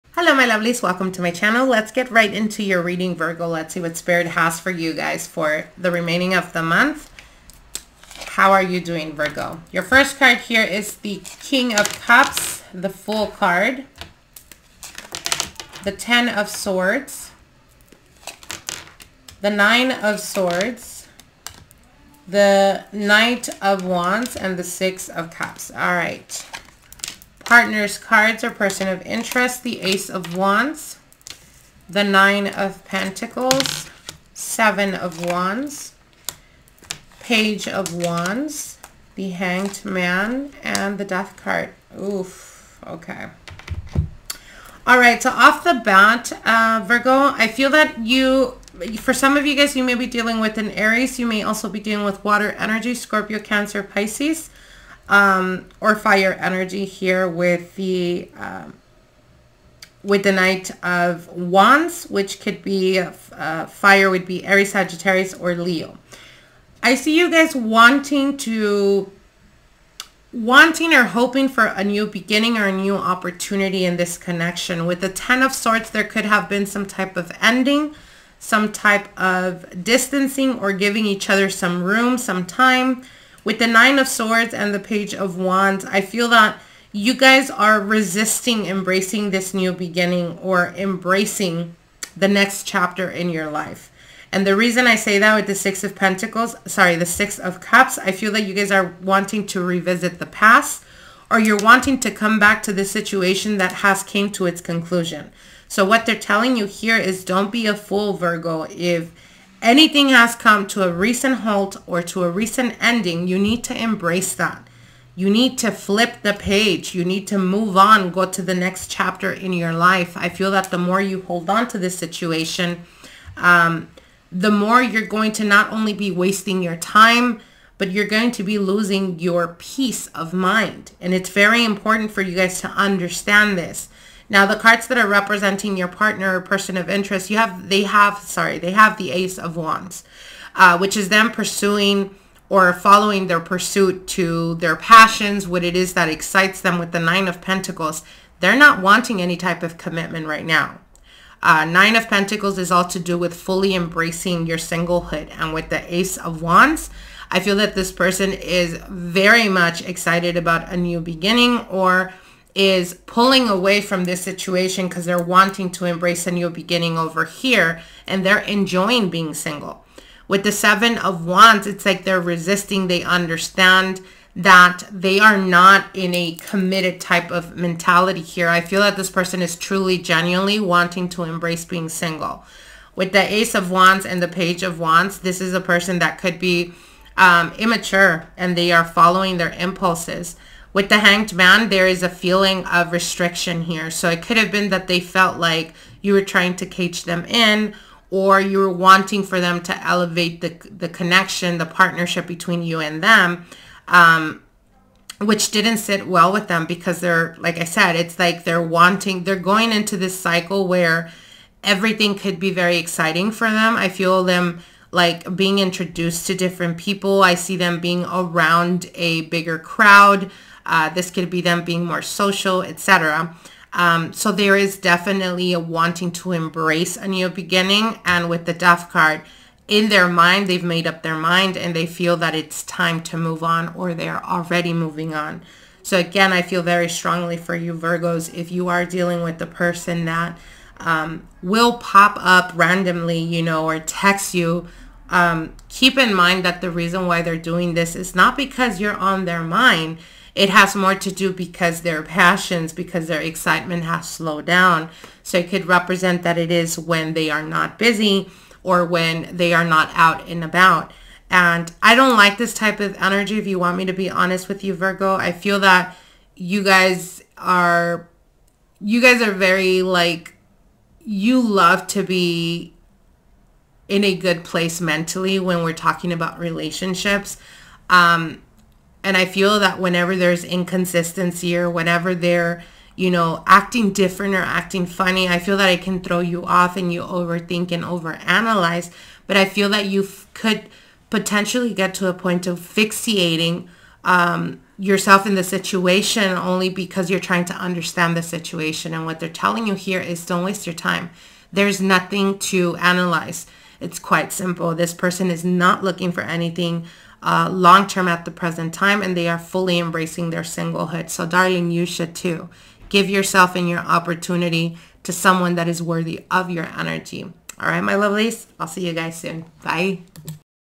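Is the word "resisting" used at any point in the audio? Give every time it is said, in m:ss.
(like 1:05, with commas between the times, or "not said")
1:27, 2:52.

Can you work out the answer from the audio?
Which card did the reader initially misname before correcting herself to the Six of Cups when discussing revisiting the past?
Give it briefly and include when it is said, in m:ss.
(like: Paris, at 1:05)
Six of Pentacles, at 1:35.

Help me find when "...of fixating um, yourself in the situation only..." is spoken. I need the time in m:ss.
4:52.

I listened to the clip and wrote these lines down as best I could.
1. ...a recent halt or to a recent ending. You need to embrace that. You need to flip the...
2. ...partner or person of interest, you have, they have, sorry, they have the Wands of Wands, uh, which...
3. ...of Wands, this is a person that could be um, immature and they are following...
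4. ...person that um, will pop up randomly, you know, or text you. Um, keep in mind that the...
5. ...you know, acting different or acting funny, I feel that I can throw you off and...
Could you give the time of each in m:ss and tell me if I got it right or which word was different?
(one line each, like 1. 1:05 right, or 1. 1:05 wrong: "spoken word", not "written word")
1. 1:50 right
2. 2:15 wrong: "Ace", not "Wands"
3. 3:04 right
4. 3:59 right
5. 4:42 right.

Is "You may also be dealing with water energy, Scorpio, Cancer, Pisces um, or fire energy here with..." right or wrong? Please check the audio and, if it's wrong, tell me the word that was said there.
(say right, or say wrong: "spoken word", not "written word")
right.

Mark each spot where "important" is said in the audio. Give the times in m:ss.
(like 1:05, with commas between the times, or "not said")
2:11.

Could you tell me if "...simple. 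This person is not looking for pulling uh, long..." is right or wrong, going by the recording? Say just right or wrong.
wrong.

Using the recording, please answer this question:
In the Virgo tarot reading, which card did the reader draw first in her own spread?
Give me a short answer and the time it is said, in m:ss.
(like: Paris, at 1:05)
King of Cups, at 0:11.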